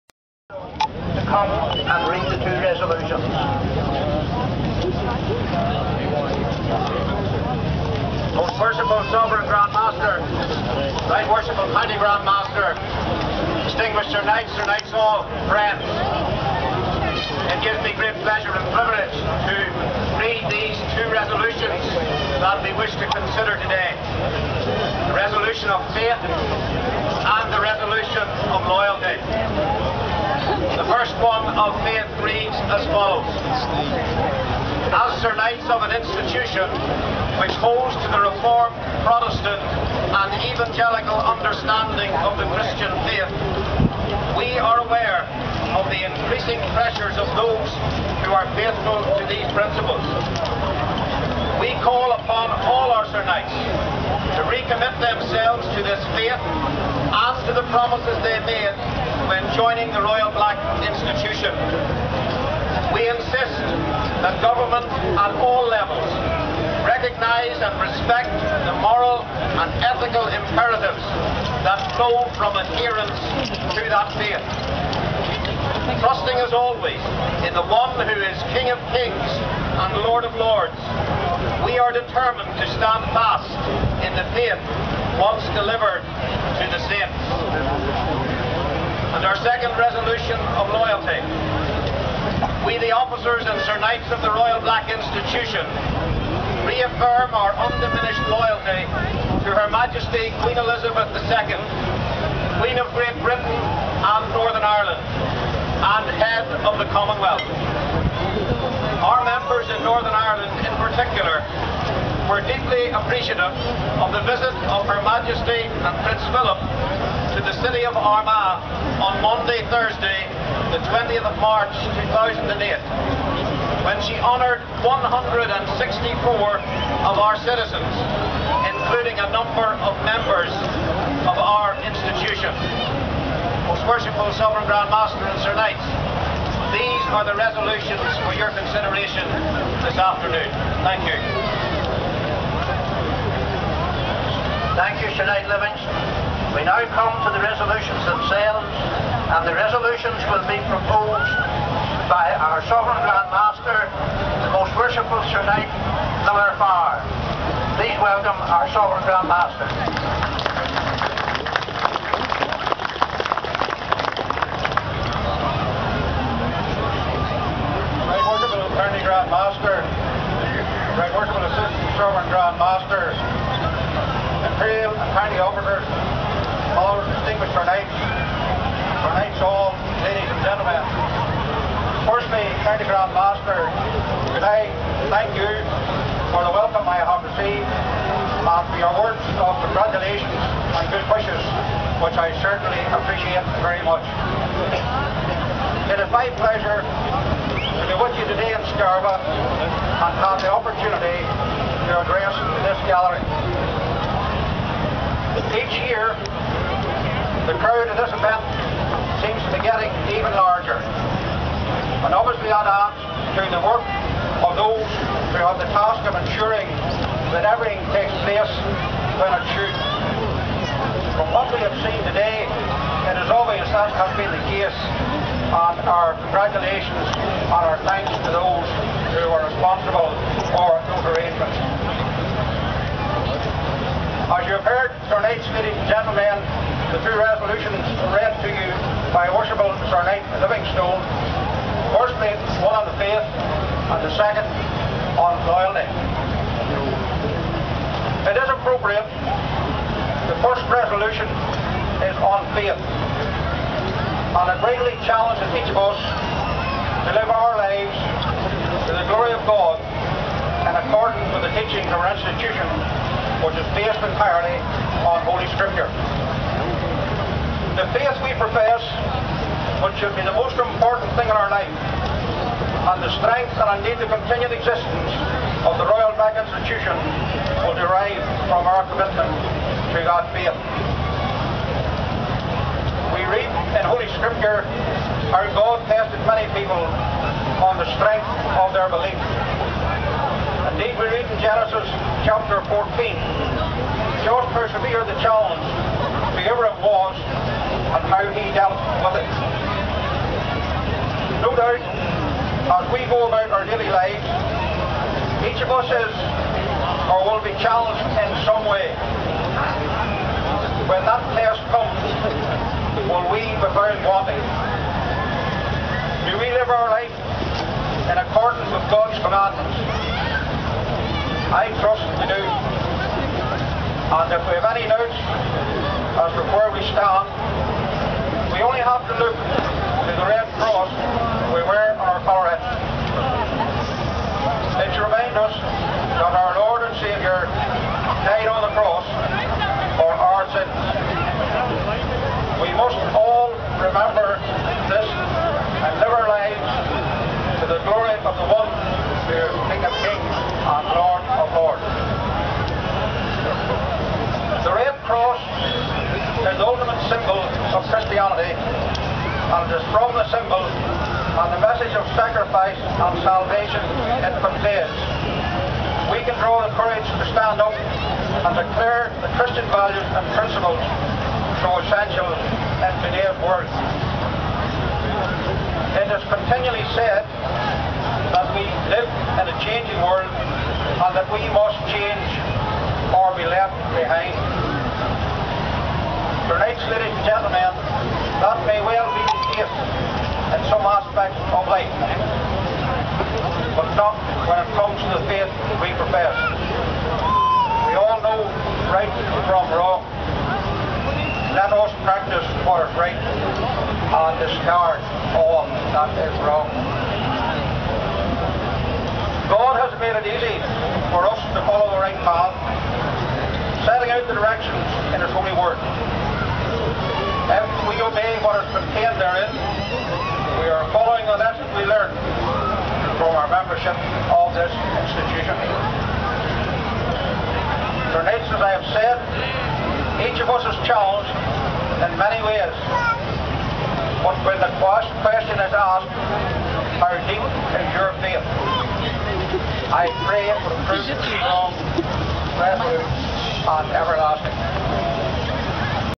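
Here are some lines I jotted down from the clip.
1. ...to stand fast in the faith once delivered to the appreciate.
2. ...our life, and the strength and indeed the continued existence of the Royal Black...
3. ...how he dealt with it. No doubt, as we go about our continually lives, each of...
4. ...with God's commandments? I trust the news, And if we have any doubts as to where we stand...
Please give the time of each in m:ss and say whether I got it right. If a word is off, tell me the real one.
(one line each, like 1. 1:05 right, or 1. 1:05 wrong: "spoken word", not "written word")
1. 1:22 wrong: "state", not "appreciate"
2. 4:31 right
3. 4:58 wrong: "daily", not "continually"
4. 5:18 right.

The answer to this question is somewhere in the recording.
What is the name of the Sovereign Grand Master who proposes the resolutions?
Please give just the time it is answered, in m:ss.
2:36.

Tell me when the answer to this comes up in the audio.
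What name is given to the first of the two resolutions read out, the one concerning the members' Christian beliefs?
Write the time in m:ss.
0:25.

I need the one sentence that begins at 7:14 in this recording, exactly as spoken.
But when the question is asked, how deep is your faith?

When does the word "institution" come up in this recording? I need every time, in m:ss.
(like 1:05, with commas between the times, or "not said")
0:35, 1:00, 1:34, 2:11, 4:22, 4:36, 7:05.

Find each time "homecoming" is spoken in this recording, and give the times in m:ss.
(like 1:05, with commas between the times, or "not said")
not said.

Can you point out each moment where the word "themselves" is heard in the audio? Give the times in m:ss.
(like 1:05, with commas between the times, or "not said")
0:55, 2:28.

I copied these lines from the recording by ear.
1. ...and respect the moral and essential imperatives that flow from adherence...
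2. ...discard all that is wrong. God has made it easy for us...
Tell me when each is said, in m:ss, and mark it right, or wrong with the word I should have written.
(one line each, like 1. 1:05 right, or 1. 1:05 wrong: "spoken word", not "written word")
1. 1:07 wrong: "ethical", not "essential"
2. 6:44 right.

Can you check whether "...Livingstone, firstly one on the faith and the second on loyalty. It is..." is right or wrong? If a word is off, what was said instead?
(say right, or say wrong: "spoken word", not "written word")
right.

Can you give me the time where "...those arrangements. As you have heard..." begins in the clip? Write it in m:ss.
3:50.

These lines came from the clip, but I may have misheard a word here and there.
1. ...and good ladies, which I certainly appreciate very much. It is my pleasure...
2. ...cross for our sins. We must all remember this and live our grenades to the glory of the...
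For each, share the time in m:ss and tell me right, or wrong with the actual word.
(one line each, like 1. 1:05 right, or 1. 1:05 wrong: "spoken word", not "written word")
1. 3:10 wrong: "wishes", not "ladies"
2. 5:38 wrong: "lives", not "grenades".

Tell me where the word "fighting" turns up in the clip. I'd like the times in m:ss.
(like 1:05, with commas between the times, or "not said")
not said.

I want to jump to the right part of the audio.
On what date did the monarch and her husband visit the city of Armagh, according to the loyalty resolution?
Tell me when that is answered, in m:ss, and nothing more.
2:00.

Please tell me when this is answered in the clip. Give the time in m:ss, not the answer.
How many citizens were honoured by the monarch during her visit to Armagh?
2:04.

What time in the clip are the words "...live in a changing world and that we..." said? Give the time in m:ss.
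6:18.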